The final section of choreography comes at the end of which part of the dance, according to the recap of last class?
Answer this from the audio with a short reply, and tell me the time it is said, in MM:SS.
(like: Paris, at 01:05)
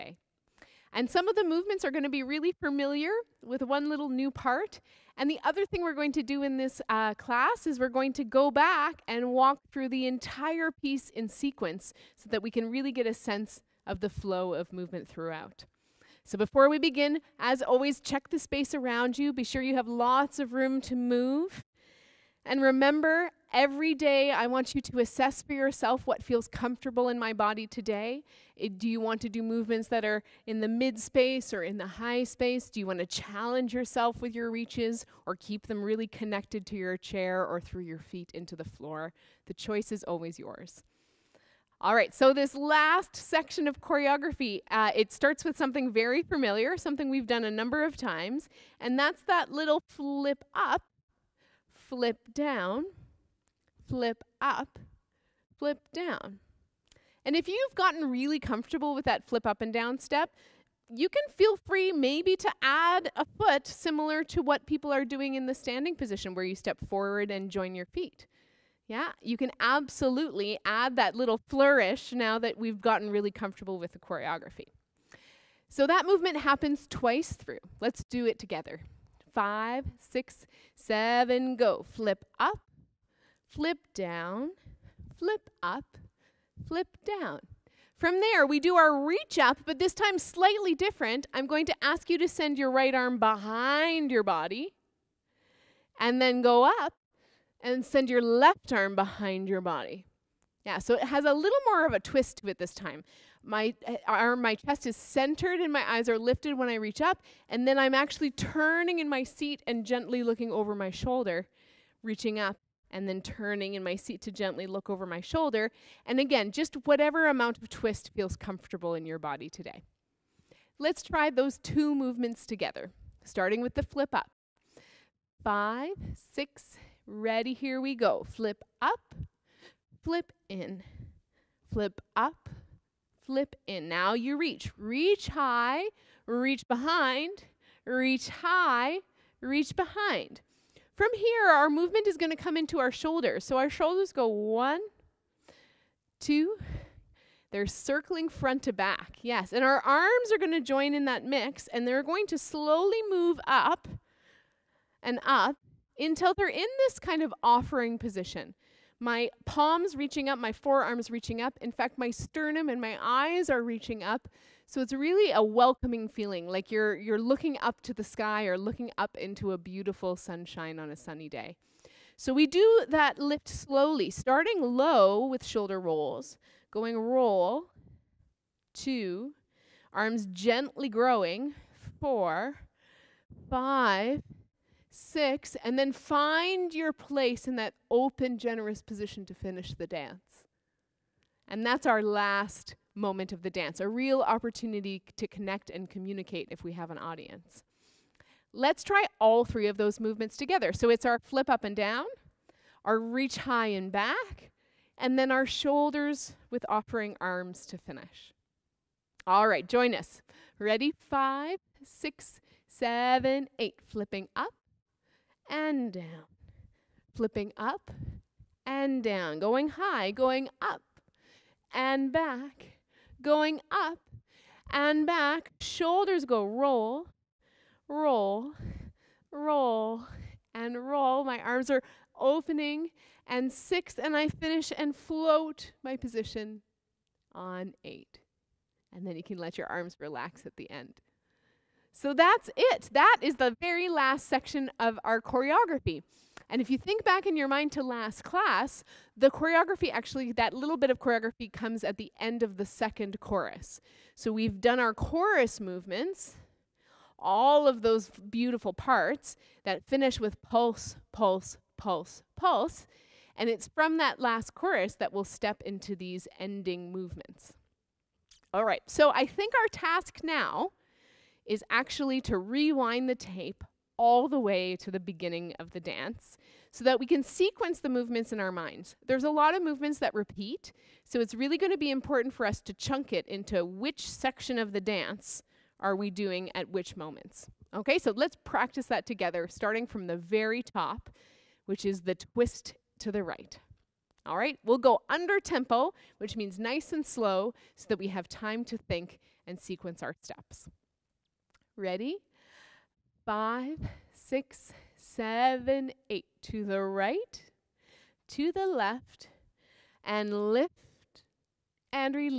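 the second chorus, at 04:12.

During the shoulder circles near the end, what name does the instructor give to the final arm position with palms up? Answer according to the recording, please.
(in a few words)
offering position.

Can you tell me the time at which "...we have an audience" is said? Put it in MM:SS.
03:16.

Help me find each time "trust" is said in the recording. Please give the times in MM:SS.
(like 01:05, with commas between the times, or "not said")
not said.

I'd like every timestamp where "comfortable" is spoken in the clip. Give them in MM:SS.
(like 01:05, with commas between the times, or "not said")
00:26, 00:58, 01:13, 01:58.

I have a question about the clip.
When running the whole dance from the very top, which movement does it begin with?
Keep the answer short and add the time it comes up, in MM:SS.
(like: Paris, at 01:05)
the twist to the right, at 04:52.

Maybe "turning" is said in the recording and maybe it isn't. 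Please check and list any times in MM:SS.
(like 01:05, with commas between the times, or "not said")
01:48, 01:53.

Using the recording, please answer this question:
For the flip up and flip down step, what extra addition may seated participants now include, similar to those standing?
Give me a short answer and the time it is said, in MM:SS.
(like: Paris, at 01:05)
a foot, at 01:02.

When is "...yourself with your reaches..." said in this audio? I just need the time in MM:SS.
00:33.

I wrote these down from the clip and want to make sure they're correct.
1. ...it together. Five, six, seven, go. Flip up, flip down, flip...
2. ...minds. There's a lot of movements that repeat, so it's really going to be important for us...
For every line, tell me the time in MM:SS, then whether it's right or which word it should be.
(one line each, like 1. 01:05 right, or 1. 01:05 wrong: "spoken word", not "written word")
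1. 01:18 right
2. 04:38 right.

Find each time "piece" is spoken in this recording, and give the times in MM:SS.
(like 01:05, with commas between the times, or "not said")
00:10.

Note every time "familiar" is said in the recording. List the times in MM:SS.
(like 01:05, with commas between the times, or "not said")
00:02, 00:46.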